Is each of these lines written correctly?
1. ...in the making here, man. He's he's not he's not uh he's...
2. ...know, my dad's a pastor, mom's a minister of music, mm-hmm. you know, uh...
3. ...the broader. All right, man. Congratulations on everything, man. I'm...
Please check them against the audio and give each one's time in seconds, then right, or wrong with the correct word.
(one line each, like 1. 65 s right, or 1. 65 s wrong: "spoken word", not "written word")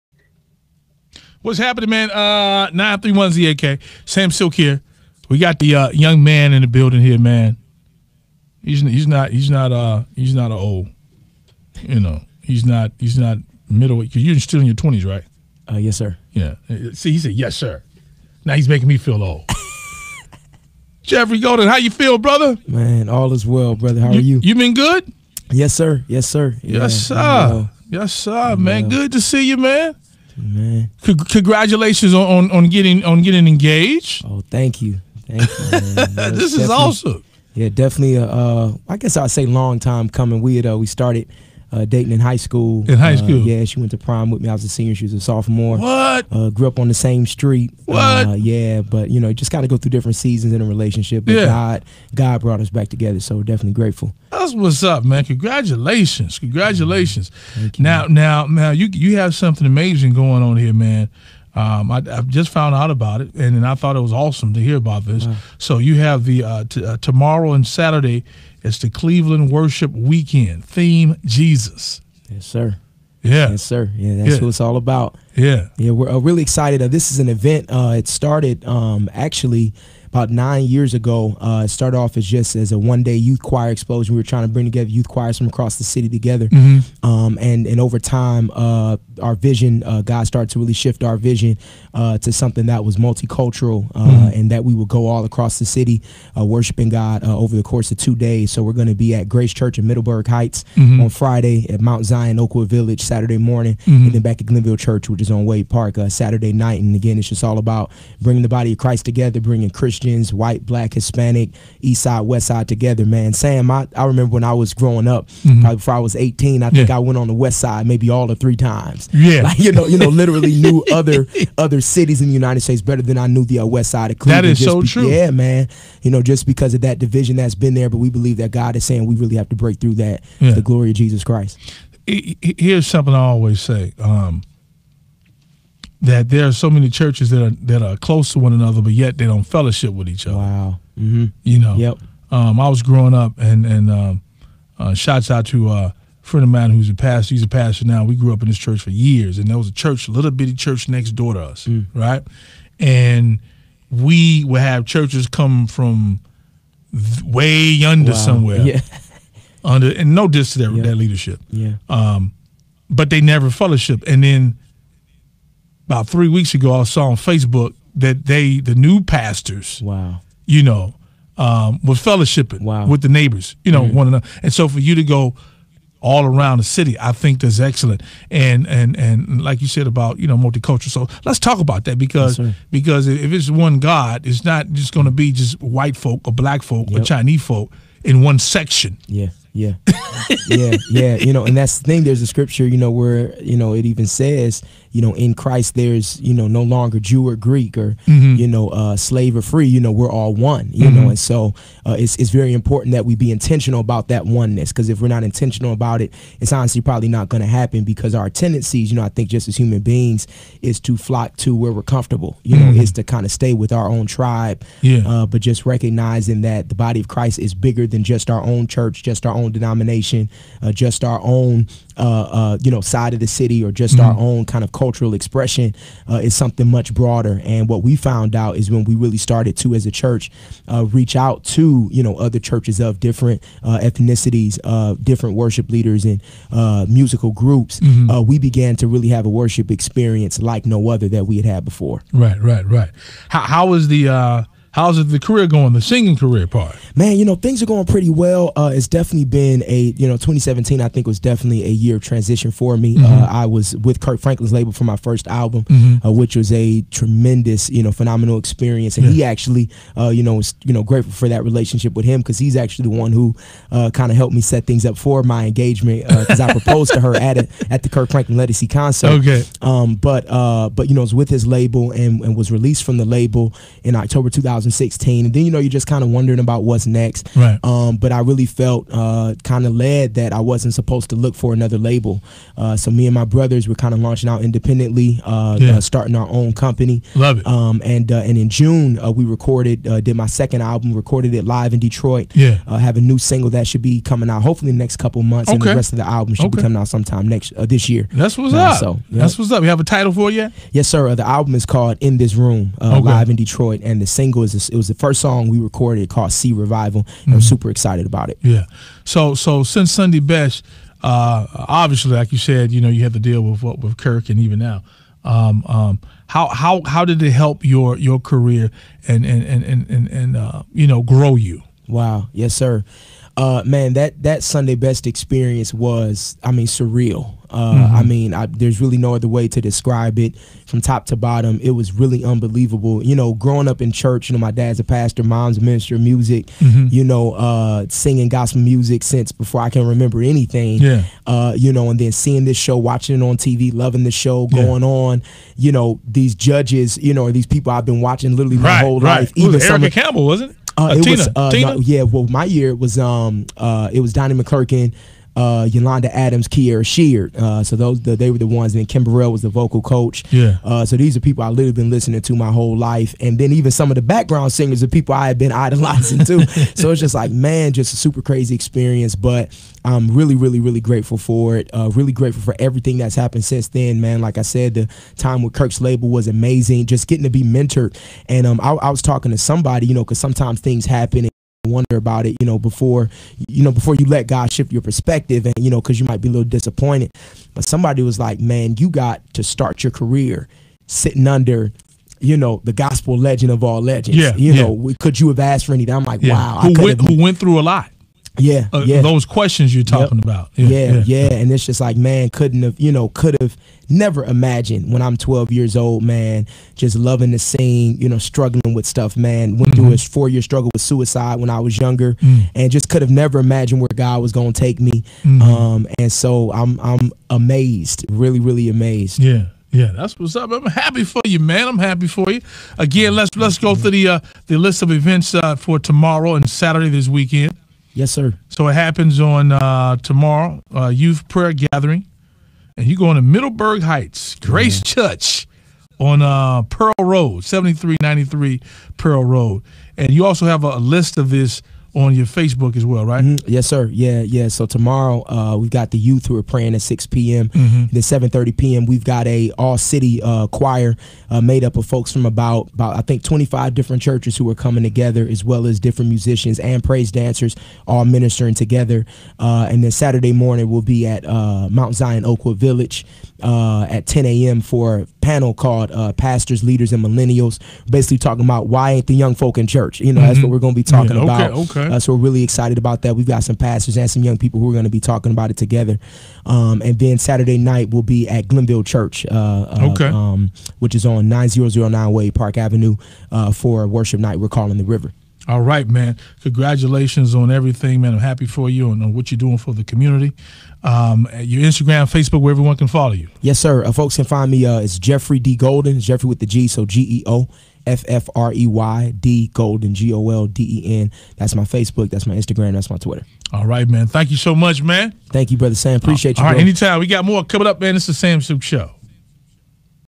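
1. 6 s wrong: "building", not "making"
2. 334 s right
3. 484 s wrong: "river", not "broader".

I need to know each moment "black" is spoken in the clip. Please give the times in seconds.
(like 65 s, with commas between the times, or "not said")
110 s, 186 s.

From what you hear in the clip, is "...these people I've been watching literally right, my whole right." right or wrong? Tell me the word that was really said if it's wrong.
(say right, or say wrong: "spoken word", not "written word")
right.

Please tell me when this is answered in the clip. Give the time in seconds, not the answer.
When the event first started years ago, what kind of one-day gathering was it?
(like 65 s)
83 s.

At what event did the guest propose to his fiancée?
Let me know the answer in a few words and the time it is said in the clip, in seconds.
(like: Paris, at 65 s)
Kirk Franklin Legacy concert, at 267 s.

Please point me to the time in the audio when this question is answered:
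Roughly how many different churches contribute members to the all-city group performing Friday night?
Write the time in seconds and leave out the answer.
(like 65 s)
453 s.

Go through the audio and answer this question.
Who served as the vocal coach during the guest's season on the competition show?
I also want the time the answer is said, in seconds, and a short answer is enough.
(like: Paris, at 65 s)
Kim Burrell, at 358 s.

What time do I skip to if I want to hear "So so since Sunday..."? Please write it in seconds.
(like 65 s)
309 s.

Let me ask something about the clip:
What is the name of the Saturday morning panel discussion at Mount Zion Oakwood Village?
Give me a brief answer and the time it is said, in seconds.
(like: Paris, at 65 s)
Pastors, Leaders, and Millennials, at 466 s.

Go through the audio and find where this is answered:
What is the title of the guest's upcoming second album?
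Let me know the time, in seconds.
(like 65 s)
302 s.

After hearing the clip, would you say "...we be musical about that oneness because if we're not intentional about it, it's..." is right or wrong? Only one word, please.
wrong.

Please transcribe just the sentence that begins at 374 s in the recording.
Like I said, the time with Kirk's label was amazing.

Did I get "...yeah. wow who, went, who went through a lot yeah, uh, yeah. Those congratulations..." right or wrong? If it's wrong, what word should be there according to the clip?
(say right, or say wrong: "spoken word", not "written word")
wrong: "questions", not "congratulations".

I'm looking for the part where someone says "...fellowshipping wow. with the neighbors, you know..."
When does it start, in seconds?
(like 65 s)
171 s.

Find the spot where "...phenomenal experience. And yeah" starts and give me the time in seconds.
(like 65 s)
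257 s.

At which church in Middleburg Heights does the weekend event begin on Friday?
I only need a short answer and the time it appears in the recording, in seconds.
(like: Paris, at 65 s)
Grace Church, at 99 s.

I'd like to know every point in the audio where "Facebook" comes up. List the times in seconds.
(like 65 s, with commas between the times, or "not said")
167 s, 442 s, 492 s, 501 s.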